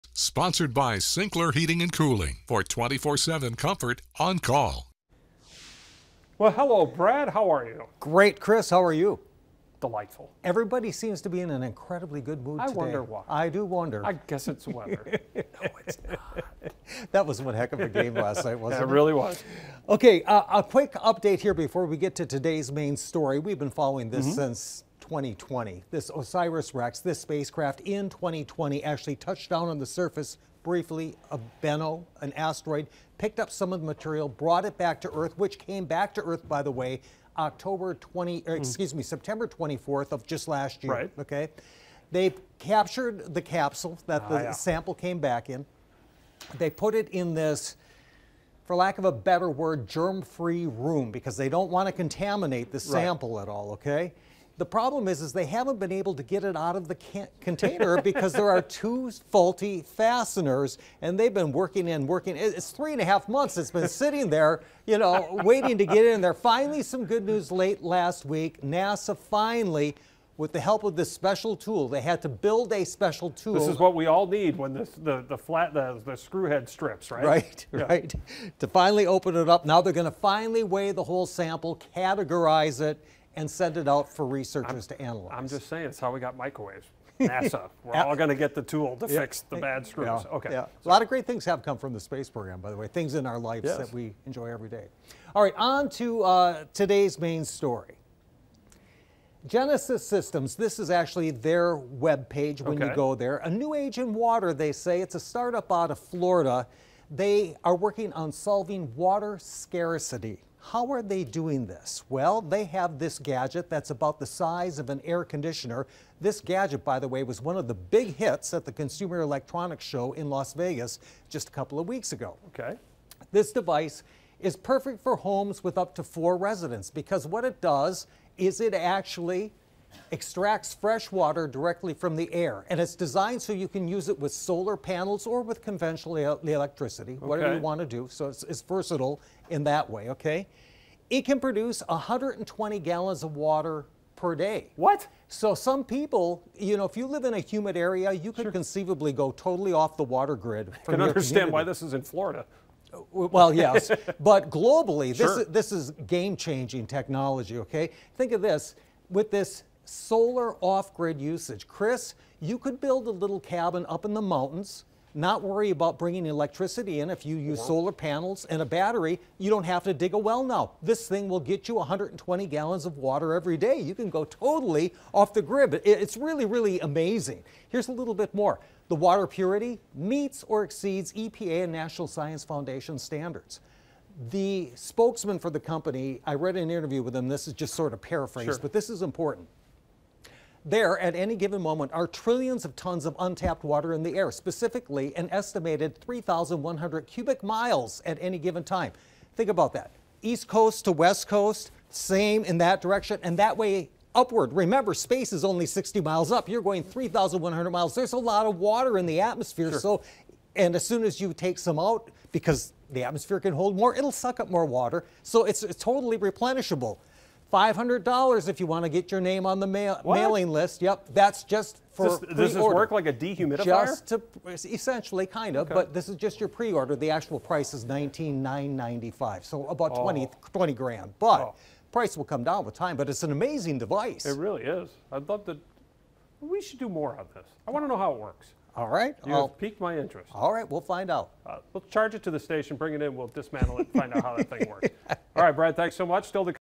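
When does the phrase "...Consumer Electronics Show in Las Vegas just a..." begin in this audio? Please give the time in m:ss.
1:58.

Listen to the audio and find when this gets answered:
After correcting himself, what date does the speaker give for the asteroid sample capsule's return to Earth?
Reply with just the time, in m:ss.
0:39.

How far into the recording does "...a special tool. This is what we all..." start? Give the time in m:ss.
1:12.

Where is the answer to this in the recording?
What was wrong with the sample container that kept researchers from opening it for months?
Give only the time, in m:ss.
0:58.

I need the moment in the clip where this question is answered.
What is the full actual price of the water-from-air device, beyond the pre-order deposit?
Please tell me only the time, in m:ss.
3:47.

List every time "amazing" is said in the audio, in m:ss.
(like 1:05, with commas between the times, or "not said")
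2:56, 3:53.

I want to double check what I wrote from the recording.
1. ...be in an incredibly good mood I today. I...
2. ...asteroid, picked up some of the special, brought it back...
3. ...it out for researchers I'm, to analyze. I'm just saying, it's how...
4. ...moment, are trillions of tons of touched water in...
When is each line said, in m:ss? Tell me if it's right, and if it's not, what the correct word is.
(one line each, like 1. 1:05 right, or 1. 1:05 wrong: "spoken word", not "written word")
1. 0:11 right
2. 0:32 wrong: "material", not "special"
3. 1:23 right
4. 3:11 wrong: "untapped", not "touched".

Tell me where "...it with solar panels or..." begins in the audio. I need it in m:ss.
2:14.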